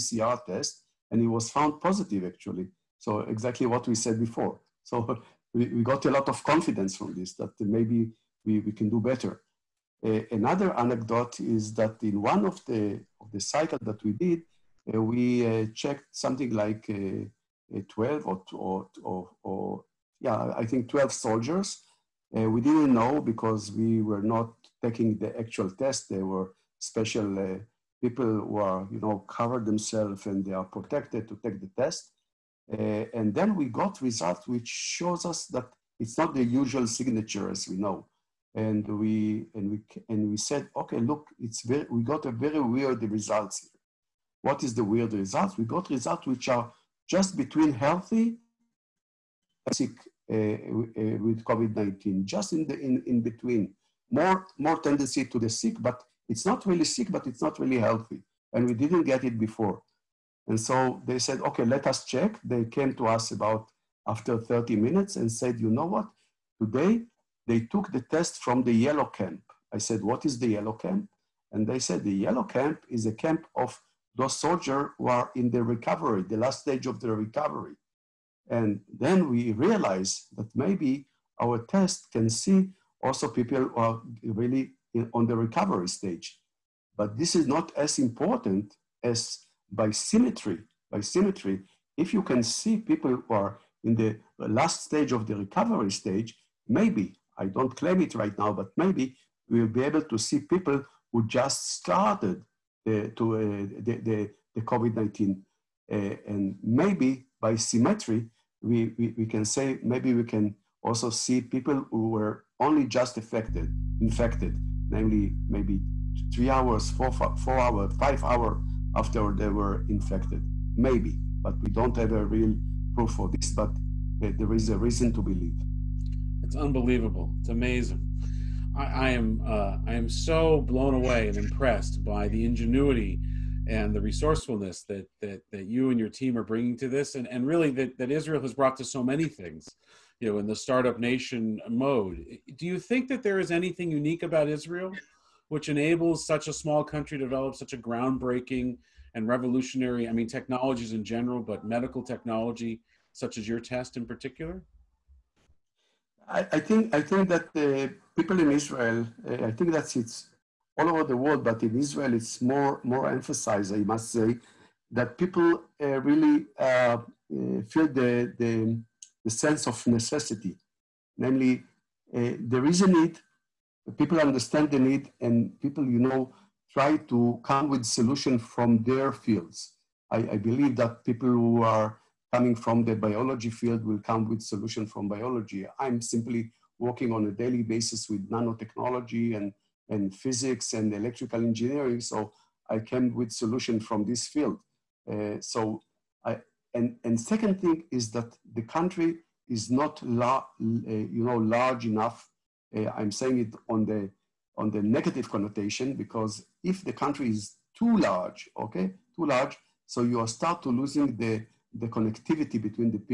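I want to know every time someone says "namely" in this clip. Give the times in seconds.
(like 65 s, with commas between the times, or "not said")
114 s, 171 s.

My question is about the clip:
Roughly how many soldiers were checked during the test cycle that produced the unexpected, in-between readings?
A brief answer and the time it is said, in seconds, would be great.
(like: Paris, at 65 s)
12, at 20 s.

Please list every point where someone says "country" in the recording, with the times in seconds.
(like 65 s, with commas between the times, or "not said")
146 s, 198 s, 206 s.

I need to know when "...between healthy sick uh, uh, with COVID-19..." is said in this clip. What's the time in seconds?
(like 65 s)
47 s.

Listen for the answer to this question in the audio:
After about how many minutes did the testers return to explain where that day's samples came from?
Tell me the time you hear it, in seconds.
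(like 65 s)
64 s.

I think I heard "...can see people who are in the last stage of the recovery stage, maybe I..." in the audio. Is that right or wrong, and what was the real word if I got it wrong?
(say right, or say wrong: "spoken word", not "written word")
right.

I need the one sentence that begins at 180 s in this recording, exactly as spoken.
I, I believe that people who are coming from the biology field will come with solution from biology.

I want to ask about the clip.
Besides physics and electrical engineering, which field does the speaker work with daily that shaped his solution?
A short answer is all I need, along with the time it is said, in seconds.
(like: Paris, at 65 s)
nanotechnology, at 188 s.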